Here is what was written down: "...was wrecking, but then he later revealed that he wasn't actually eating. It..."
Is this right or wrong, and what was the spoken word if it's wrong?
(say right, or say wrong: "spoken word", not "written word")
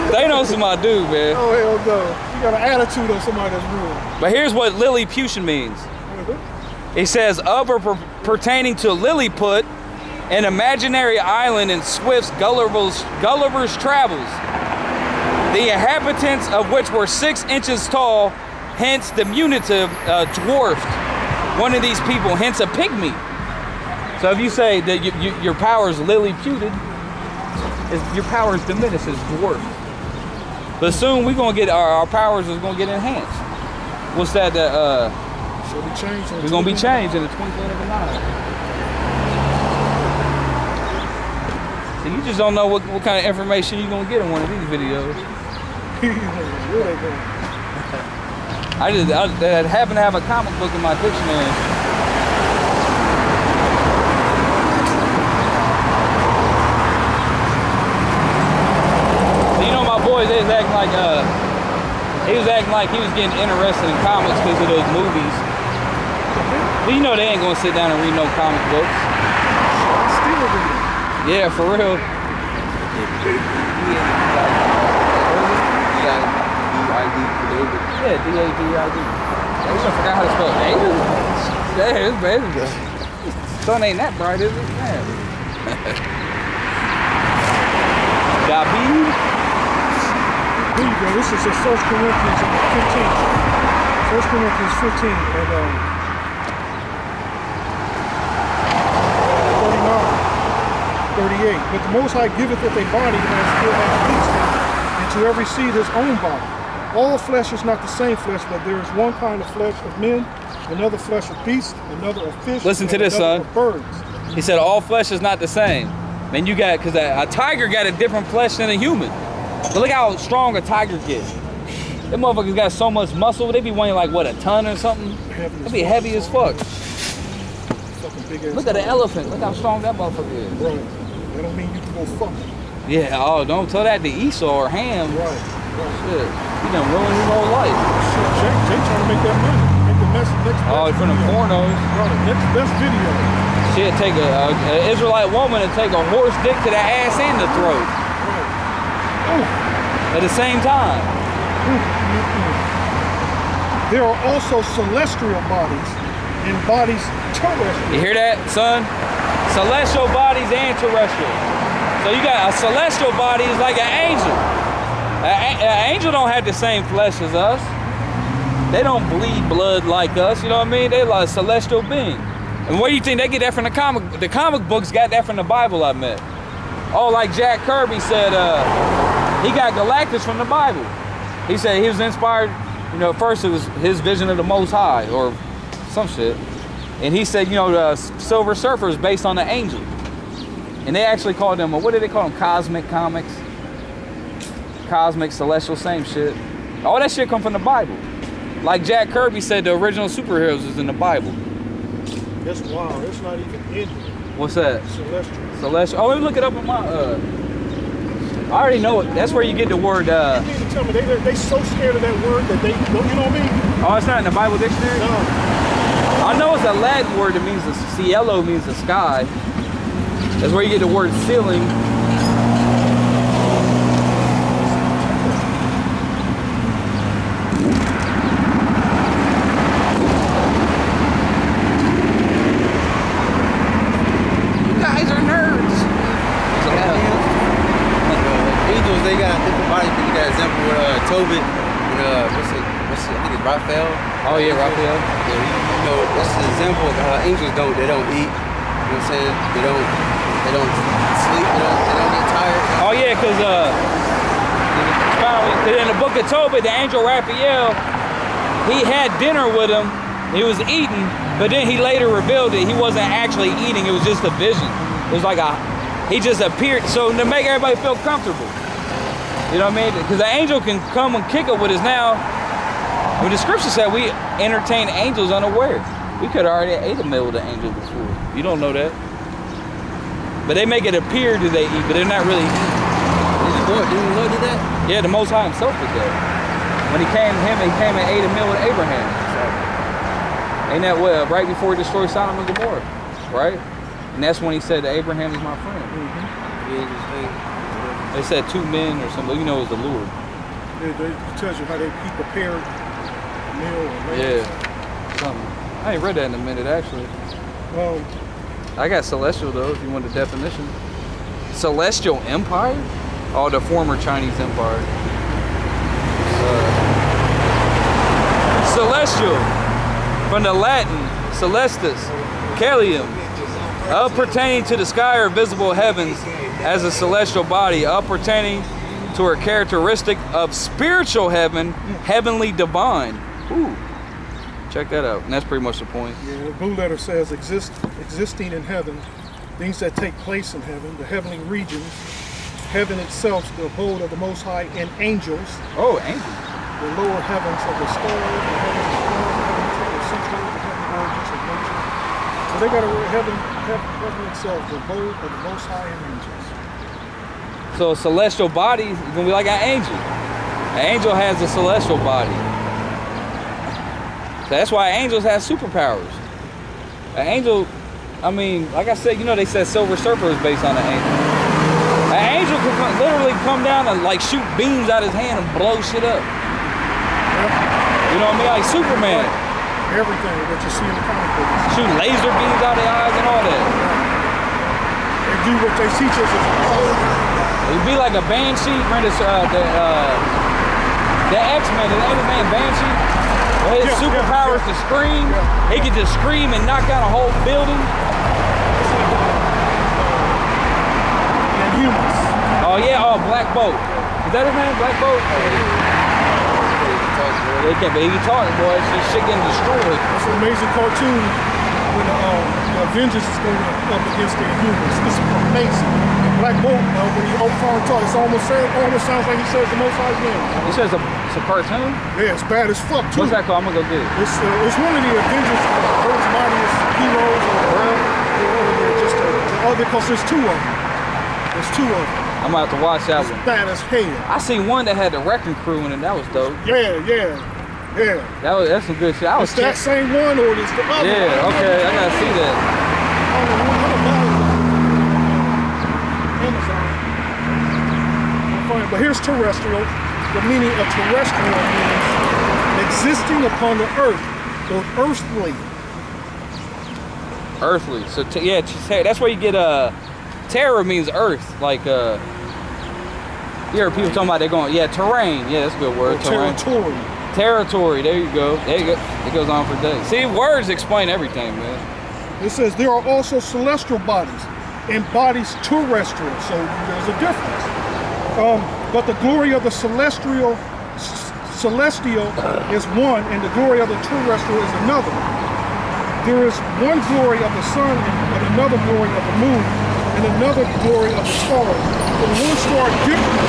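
wrong: "eating", not "wrecking".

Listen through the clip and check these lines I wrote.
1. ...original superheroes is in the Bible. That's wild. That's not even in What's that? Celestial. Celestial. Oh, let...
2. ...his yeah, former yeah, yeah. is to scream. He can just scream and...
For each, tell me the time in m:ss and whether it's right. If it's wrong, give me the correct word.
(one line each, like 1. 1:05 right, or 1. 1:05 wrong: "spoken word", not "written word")
1. 3:19 right
2. 6:33 wrong: "superpower", not "former".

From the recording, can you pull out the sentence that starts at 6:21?
Shoot laser beams out of their eyes and all that.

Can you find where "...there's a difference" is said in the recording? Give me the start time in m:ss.
7:56.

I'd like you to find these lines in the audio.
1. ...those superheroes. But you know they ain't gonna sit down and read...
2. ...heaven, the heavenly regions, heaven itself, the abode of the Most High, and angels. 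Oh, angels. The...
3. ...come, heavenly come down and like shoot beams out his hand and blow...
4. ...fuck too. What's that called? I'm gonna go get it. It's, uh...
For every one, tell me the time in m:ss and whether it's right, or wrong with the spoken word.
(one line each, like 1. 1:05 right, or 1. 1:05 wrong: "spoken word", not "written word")
1. 1:04 wrong: "movies", not "superheroes"
2. 5:40 right
3. 6:12 wrong: "literally", not "heavenly"
4. 7:02 right.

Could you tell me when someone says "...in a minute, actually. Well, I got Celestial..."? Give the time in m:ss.
5:06.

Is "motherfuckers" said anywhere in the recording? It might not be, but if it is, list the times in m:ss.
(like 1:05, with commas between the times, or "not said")
2:02, 2:09.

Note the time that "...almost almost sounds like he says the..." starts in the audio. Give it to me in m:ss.
6:58.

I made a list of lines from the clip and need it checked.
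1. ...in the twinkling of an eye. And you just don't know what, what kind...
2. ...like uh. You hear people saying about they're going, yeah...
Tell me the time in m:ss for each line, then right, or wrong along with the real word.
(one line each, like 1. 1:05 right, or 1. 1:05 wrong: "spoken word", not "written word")
1. 0:37 right
2. 7:41 wrong: "talking", not "saying".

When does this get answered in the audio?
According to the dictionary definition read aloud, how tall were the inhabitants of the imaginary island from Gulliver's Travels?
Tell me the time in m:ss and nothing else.
0:17.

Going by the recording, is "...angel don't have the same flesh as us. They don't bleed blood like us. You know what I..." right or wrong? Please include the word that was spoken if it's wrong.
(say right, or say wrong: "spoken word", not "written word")
right.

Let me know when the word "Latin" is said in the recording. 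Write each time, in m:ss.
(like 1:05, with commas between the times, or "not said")
3:36, 5:20.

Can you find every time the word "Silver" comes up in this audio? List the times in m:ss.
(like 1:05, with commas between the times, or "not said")
3:07, 6:09.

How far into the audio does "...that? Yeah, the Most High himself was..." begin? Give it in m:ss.
4:44.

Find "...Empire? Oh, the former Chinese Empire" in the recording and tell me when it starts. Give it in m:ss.
5:12.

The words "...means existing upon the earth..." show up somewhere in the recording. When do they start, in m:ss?
7:31.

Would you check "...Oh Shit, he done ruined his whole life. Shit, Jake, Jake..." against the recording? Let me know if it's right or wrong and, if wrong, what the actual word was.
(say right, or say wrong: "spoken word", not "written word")
right.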